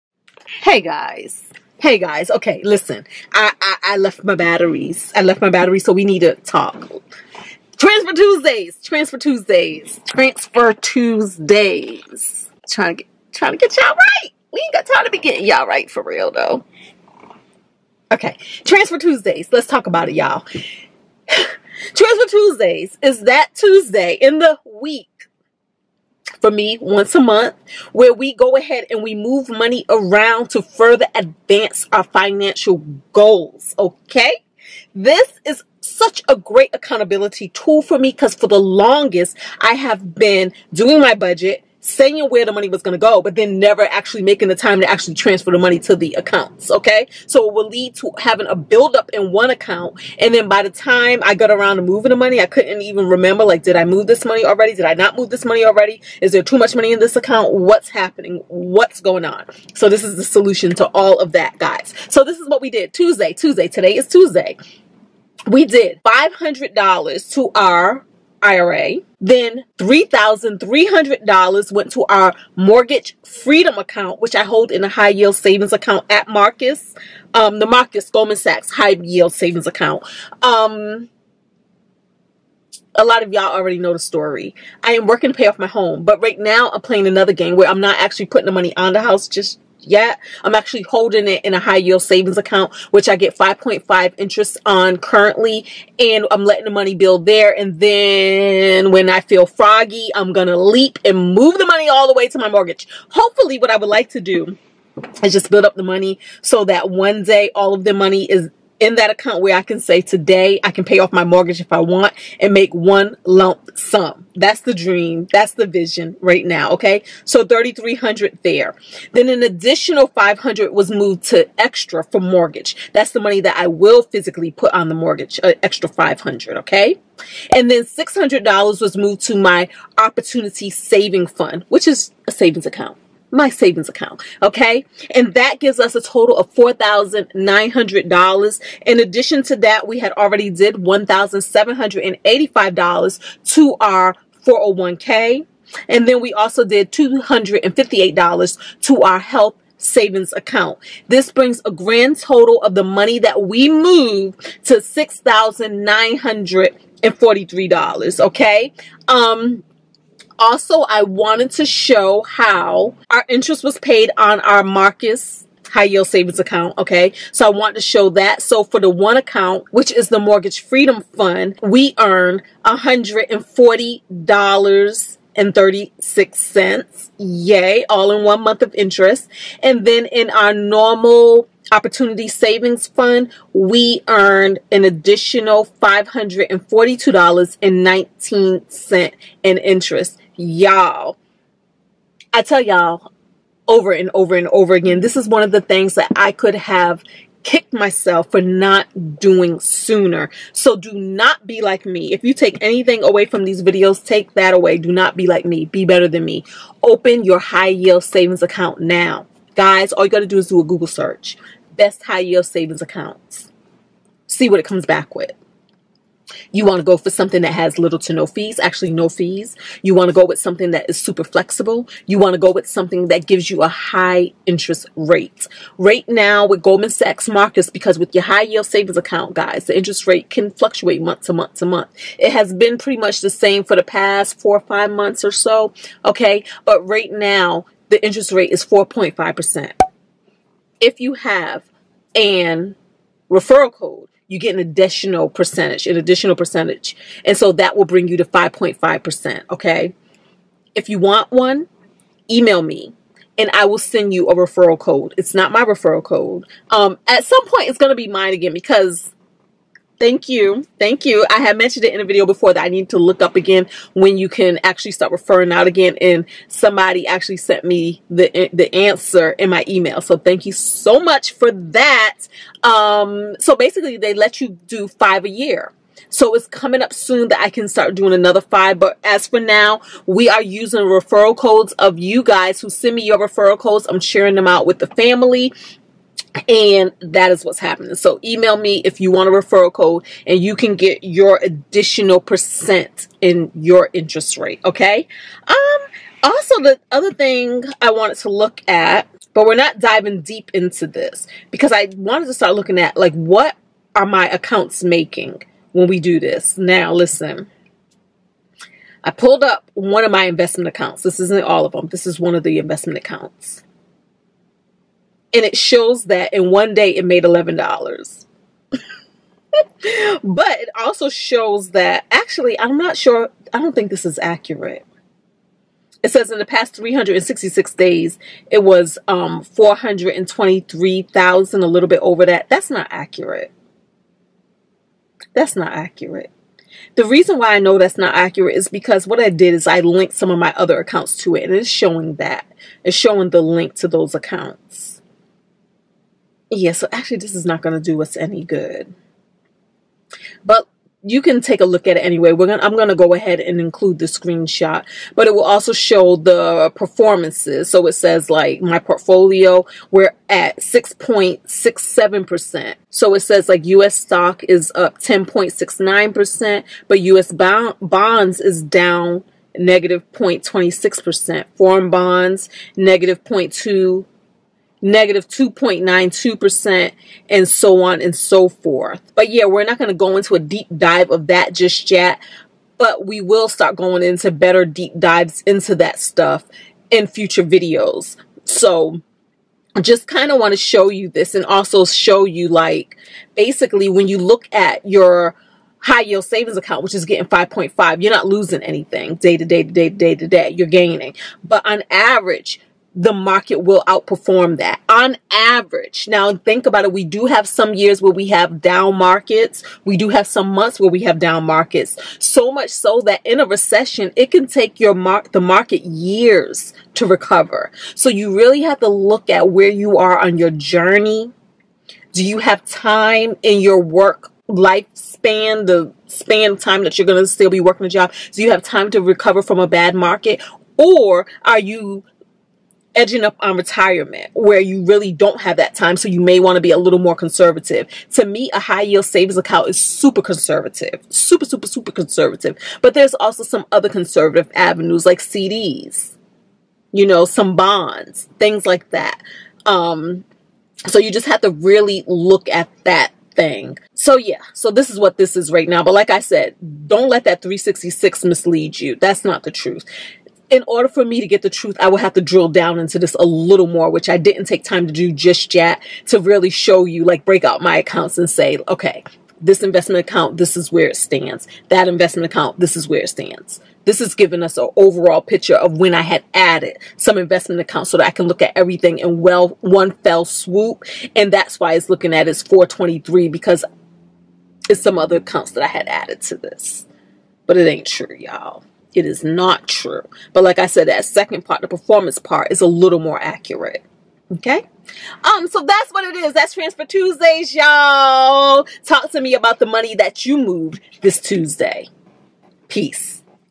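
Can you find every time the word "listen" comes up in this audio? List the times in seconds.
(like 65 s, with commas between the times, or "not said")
2 s, 306 s.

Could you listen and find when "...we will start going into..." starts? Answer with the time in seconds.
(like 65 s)
383 s.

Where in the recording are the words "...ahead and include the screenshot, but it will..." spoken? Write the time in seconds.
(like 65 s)
353 s.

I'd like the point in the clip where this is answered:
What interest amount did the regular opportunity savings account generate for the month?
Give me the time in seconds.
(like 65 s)
185 s.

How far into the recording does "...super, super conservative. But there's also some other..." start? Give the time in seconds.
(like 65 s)
441 s.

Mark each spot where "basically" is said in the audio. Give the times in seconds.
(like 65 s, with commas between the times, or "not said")
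273 s, 393 s.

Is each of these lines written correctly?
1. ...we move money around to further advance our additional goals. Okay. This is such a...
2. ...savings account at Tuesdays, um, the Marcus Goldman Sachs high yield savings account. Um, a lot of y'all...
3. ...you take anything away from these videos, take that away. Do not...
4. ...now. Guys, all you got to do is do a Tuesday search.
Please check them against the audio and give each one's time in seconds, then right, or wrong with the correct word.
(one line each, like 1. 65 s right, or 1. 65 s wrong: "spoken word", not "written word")
1. 29 s wrong: "financial", not "additional"
2. 75 s wrong: "Marcus", not "Tuesdays"
3. 202 s right
4. 208 s wrong: "Google", not "Tuesday".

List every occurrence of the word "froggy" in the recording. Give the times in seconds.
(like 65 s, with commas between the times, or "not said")
99 s.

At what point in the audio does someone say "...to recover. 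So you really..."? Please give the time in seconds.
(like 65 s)
416 s.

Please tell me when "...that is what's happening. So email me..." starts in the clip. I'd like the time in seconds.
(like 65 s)
287 s.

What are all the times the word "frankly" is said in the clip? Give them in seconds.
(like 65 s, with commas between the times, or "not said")
not said.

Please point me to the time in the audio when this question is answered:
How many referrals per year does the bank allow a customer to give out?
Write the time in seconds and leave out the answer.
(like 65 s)
274 s.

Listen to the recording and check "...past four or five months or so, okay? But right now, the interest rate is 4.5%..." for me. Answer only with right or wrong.
right.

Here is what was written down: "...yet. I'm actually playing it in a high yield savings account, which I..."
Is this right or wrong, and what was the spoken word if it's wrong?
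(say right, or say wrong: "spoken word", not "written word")
wrong: "holding", not "playing".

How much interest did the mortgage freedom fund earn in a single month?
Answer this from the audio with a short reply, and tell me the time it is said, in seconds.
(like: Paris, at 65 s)
$140.36, at 172 s.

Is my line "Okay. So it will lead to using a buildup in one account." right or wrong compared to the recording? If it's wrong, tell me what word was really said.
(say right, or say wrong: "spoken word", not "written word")
wrong: "having", not "using".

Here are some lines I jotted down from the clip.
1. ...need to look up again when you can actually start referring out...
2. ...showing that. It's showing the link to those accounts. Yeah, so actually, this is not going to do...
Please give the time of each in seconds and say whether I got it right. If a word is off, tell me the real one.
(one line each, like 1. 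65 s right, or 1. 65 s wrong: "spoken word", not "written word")
1. 262 s right
2. 341 s right.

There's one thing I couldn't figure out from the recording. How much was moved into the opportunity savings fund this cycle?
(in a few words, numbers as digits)
$600.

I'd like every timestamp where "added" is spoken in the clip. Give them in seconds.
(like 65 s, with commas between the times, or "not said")
476 s, 485 s.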